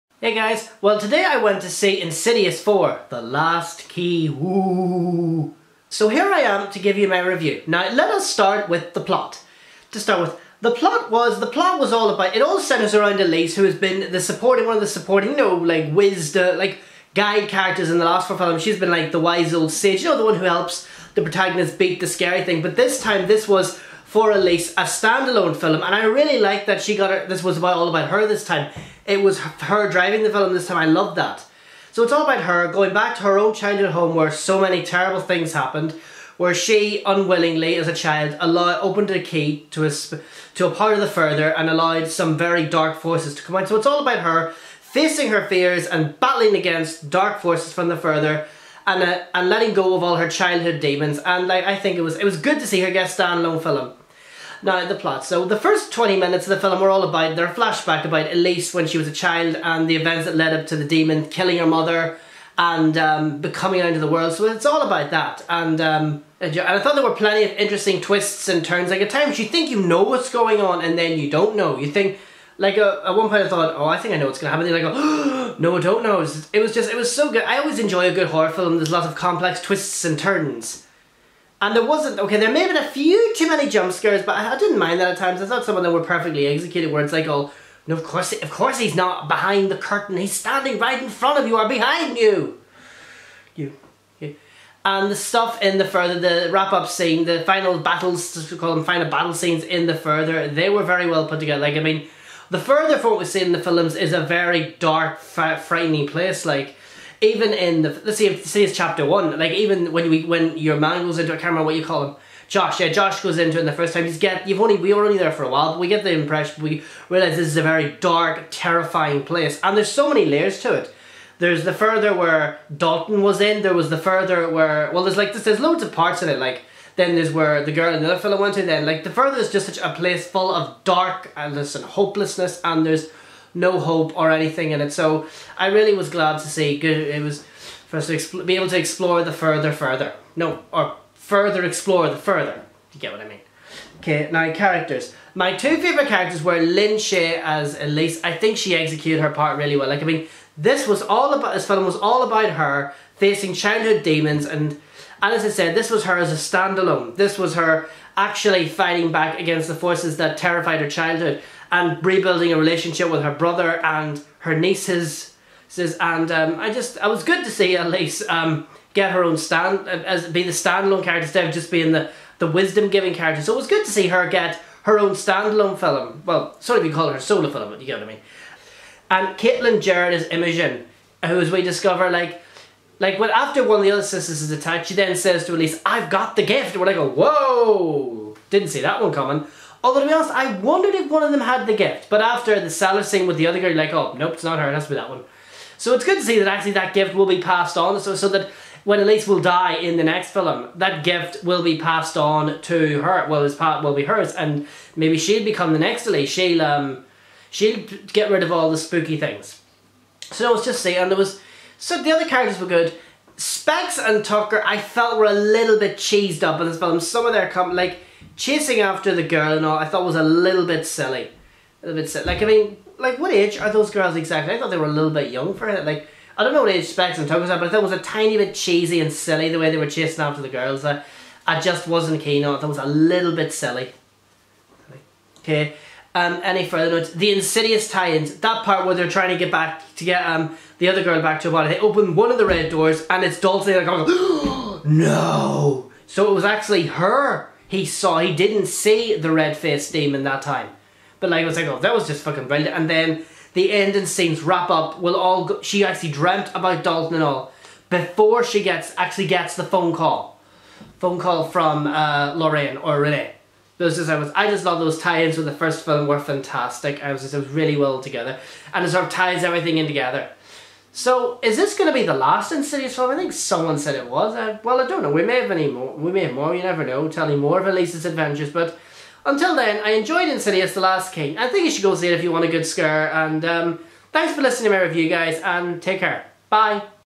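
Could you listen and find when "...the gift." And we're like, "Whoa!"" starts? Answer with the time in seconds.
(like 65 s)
186 s.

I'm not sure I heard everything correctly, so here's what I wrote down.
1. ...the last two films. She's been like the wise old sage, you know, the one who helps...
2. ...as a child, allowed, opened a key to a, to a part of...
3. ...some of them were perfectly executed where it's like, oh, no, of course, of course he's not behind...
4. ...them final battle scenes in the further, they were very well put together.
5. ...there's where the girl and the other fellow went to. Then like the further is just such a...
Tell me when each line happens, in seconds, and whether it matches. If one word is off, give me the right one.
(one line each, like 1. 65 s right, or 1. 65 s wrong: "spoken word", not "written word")
1. 17 s wrong: "four", not "two"
2. 37 s right
3. 85 s right
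4. 98 s right
5. 127 s right.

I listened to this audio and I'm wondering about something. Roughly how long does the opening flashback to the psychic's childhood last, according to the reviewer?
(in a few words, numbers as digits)
20 minutes.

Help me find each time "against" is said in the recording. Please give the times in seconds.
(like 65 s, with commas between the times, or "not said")
46 s, 159 s.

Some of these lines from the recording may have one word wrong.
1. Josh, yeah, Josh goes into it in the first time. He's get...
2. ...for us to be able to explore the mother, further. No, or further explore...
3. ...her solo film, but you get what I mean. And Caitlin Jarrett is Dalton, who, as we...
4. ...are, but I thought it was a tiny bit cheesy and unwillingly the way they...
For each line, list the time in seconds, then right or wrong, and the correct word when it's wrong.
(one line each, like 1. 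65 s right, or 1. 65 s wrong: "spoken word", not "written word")
1. 112 s right
2. 137 s wrong: "further", not "mother"
3. 177 s wrong: "Imogen", not "Dalton"
4. 227 s wrong: "silly", not "unwillingly".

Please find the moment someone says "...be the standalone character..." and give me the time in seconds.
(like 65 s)
170 s.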